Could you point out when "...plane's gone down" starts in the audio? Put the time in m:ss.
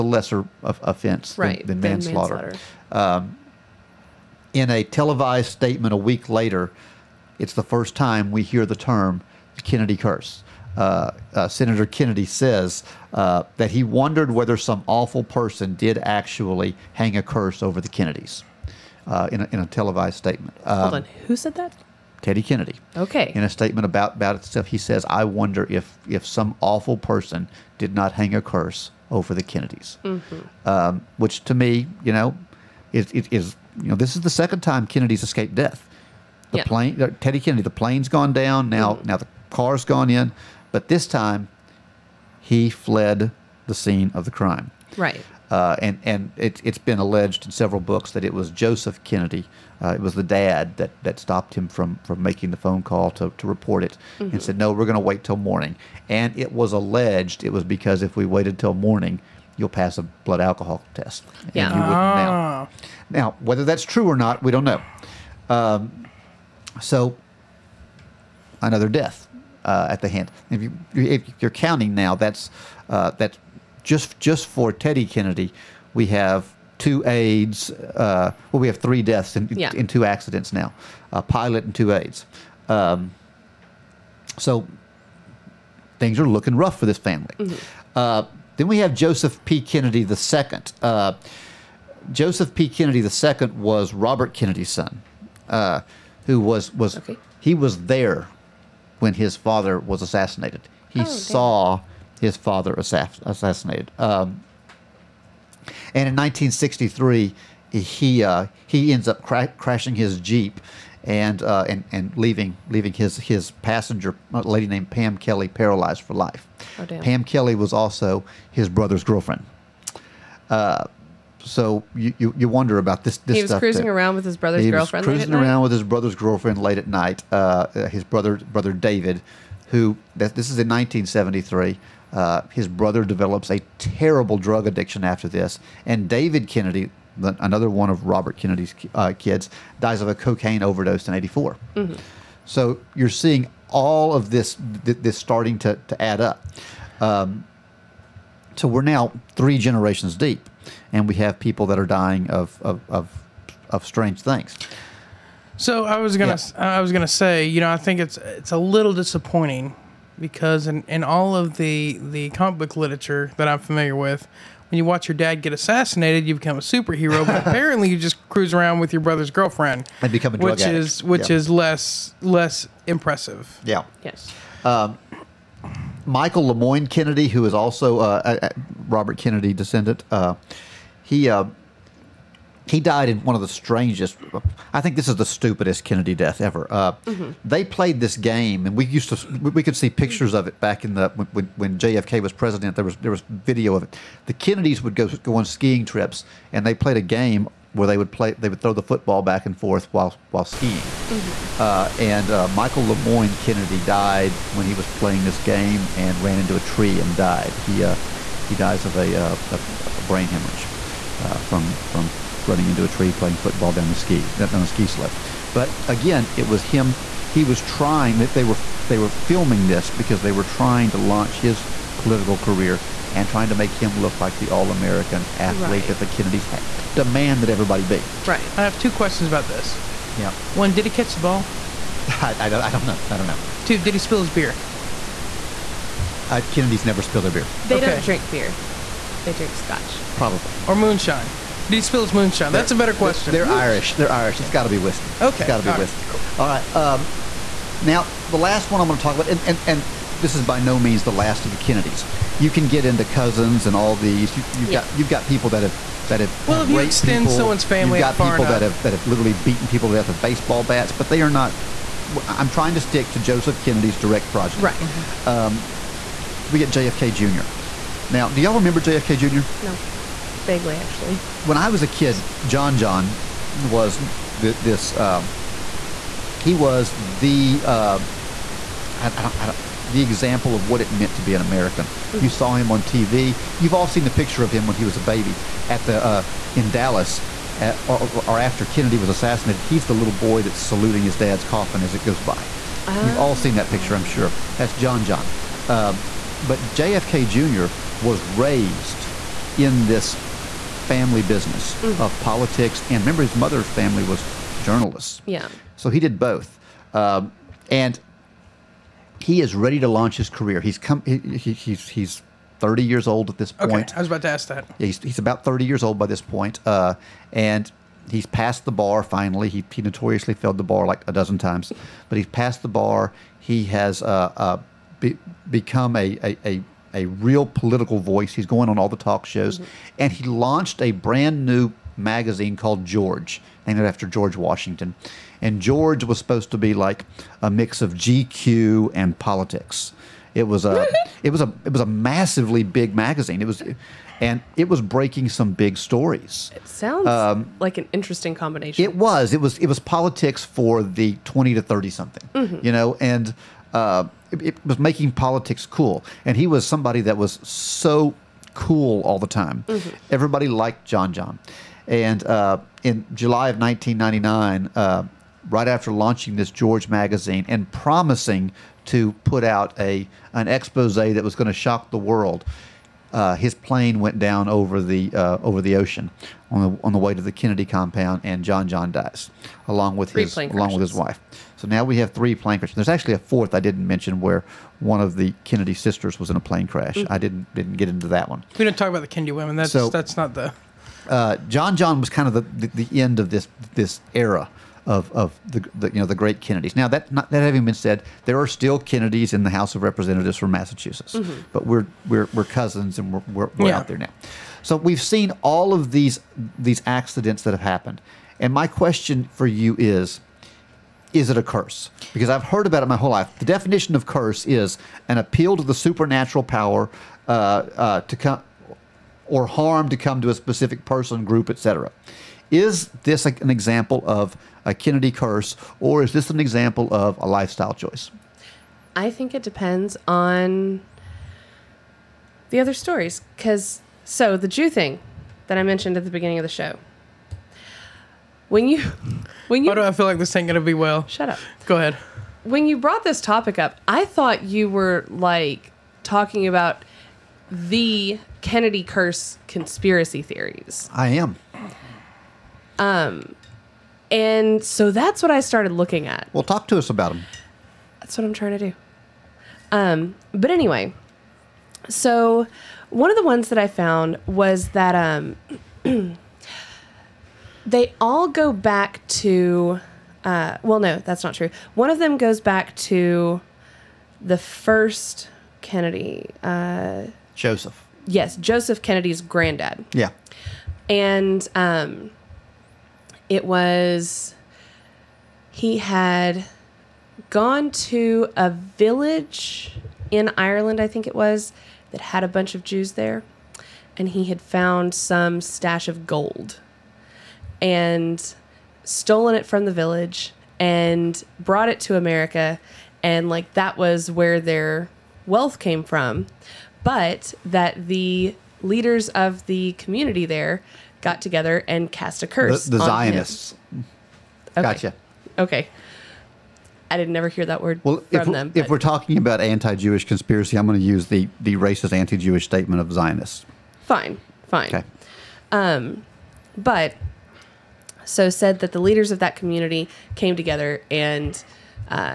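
0:37.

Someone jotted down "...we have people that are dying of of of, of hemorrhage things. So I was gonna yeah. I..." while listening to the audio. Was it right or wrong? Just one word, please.
wrong.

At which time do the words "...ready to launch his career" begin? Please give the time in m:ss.
5:09.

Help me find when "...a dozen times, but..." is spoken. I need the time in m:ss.
5:21.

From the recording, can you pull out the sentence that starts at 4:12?
You can get into cousins and all these.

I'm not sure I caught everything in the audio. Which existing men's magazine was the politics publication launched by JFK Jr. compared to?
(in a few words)
GQ.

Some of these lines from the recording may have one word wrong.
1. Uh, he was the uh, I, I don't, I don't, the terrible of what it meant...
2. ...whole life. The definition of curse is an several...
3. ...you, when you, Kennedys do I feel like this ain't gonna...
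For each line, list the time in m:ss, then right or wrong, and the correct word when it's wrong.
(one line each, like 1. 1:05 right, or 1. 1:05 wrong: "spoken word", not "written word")
1. 4:34 wrong: "example", not "terrible"
2. 6:52 wrong: "appeal", not "several"
3. 7:18 wrong: "Why", not "Kennedys".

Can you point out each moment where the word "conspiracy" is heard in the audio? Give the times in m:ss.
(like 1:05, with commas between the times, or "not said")
7:29, 8:40.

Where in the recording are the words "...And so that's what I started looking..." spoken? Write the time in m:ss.
7:34.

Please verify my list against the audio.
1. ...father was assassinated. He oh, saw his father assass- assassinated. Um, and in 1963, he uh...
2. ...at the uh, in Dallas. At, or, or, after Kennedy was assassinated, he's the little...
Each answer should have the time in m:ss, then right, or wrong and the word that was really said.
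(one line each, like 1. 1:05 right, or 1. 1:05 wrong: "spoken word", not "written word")
1. 1:39 right
2. 4:45 right.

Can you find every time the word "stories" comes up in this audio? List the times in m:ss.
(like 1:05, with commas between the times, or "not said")
5:45, 7:12.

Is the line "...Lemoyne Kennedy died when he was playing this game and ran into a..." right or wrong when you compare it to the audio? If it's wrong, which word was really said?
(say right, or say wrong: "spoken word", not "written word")
right.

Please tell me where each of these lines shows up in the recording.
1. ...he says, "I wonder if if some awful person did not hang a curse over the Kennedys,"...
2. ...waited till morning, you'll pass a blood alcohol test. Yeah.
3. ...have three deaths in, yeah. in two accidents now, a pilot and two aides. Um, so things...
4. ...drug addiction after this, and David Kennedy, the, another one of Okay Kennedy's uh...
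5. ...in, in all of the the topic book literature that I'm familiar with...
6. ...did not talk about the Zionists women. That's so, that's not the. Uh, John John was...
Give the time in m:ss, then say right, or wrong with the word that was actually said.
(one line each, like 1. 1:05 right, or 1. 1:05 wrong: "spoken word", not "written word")
1. 0:24 right
2. 0:58 right
3. 1:18 right
4. 2:14 wrong: "Robert", not "Okay"
5. 2:40 wrong: "comic", not "topic"
6. 6:28 wrong: "Kennedy", not "Zionists".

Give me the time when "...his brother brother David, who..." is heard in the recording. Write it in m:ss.
2:07.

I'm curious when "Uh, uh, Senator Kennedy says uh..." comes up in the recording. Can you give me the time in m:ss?
0:10.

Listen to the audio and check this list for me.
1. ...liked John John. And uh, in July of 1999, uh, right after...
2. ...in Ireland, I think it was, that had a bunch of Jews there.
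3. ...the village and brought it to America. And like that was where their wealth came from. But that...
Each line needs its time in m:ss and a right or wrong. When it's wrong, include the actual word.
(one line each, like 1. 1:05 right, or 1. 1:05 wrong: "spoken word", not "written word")
1. 6:00 right
2. 8:10 right
3. 8:19 right.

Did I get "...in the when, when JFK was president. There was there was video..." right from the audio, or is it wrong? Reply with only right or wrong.
right.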